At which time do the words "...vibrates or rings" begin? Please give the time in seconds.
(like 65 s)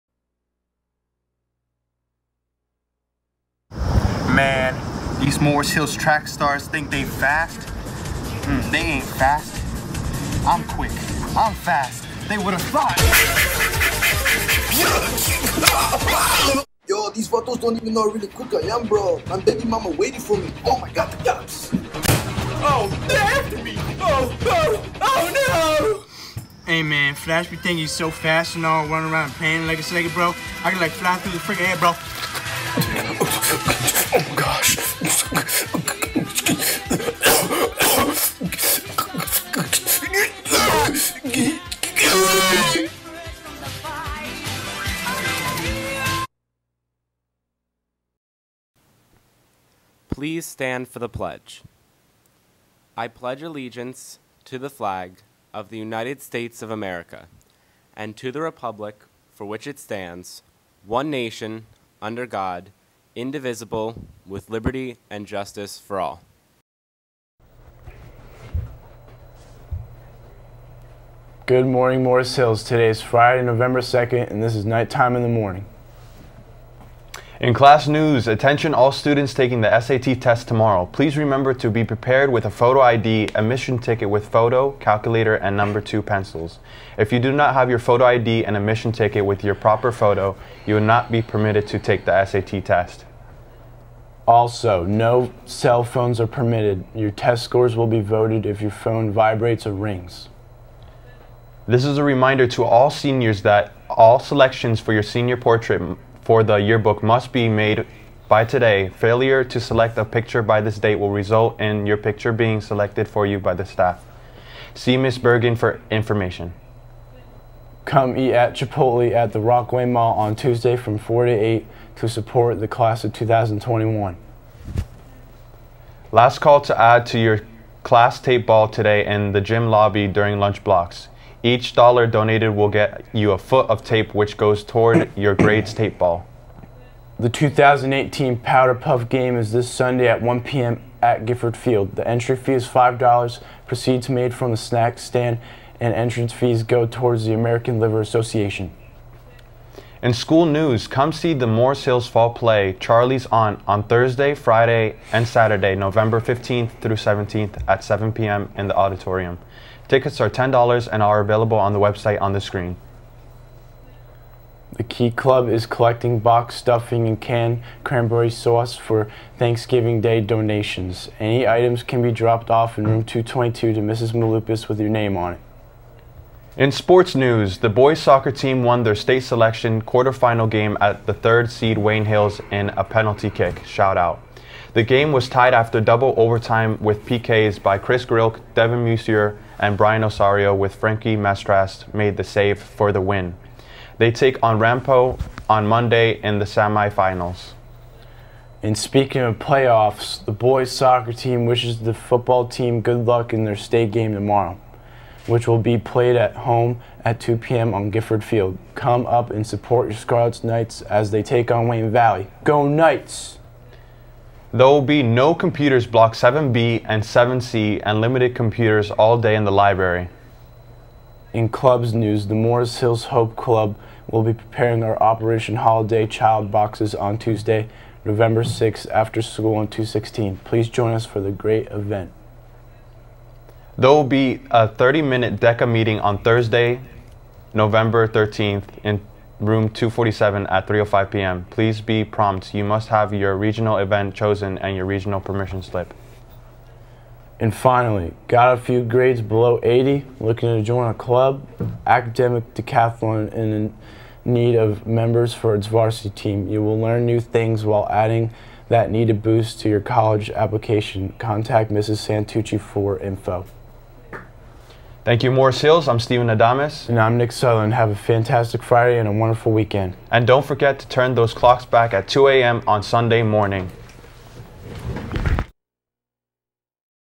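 99 s.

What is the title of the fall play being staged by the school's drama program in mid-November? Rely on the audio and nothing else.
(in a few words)
Charley's Aunt.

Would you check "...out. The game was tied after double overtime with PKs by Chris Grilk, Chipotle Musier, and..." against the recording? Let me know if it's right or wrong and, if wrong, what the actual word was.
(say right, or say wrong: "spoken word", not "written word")
wrong: "Devin", not "Chipotle".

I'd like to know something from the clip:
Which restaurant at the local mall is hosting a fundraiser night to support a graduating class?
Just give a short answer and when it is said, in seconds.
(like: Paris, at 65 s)
Chipotle, at 118 s.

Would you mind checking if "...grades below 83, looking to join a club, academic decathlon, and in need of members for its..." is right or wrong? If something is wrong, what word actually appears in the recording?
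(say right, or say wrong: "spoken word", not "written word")
wrong: "80", not "83".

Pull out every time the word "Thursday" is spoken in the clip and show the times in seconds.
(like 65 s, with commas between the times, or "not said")
153 s, 236 s.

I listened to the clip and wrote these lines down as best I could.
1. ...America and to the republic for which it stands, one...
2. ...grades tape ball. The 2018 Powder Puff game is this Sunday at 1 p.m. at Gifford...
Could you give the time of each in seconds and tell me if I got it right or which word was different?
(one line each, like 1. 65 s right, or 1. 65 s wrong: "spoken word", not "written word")
1. 56 s right
2. 135 s right.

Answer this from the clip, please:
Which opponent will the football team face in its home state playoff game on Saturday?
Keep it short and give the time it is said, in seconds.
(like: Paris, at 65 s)
Wayne Valley, at 211 s.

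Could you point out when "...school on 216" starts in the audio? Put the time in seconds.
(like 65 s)
229 s.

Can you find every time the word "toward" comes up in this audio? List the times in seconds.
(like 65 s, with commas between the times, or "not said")
134 s, 146 s.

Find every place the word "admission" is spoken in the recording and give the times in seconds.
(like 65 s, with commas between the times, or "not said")
83 s, 88 s.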